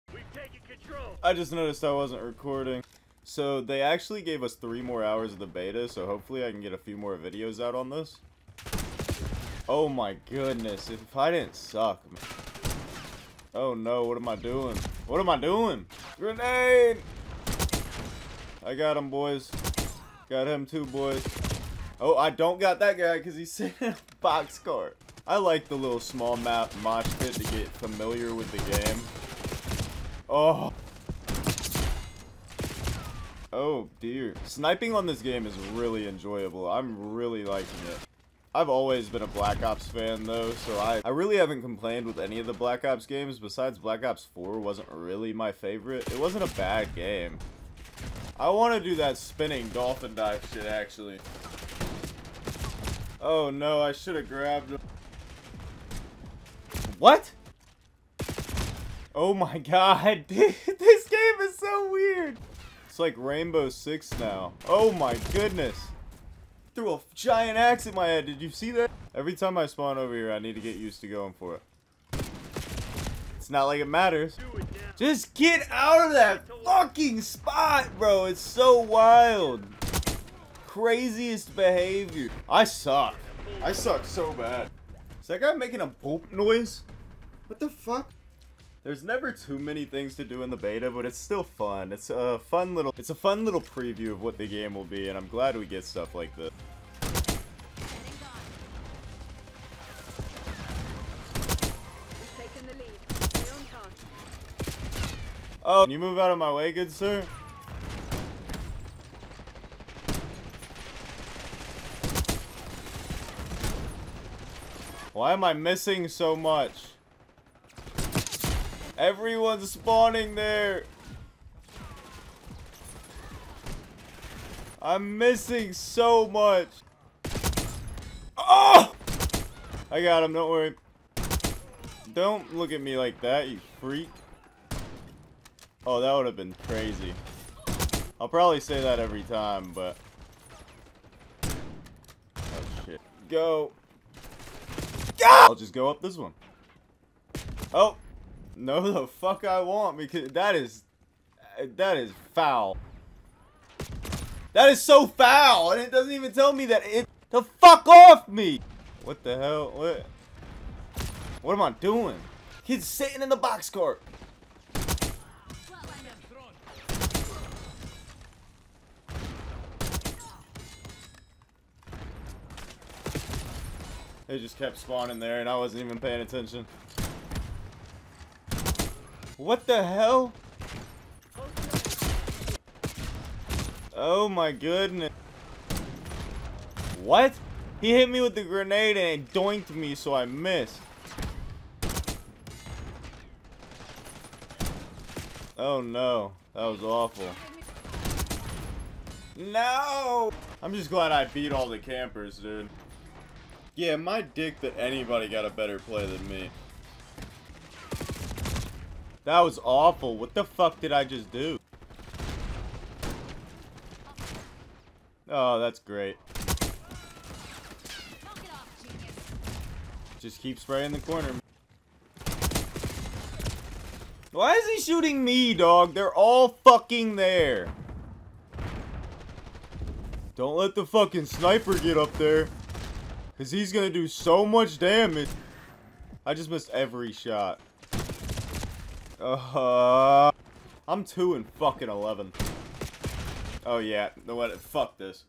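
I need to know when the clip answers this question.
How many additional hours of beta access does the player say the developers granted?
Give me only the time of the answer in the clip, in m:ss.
0:04.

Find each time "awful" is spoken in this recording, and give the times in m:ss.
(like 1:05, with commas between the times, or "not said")
3:16, 3:29.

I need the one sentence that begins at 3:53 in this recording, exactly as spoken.
Because he's going to do so much damage.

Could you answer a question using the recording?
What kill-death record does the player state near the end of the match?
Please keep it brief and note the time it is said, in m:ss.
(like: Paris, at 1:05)
2 and 11, at 4:01.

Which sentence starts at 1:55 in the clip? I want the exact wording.
Why am I missing so much?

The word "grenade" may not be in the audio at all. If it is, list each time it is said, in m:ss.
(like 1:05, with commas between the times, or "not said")
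0:16, 3:08.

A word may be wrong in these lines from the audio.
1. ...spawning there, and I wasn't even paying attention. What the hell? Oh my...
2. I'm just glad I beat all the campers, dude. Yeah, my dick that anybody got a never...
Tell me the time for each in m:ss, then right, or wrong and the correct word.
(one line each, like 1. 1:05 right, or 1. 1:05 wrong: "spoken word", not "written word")
1. 2:54 right
2. 3:20 wrong: "better", not "never".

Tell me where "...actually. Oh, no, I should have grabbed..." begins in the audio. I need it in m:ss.
0:50.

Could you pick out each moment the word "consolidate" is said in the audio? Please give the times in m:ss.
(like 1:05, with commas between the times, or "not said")
not said.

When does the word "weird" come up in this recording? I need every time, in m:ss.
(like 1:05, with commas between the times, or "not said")
1:01.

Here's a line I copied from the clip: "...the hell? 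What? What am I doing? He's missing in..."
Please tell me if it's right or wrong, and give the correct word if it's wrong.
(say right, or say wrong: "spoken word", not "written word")
wrong: "sitting", not "missing".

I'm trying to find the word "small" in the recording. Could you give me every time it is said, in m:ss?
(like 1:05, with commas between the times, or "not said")
0:25.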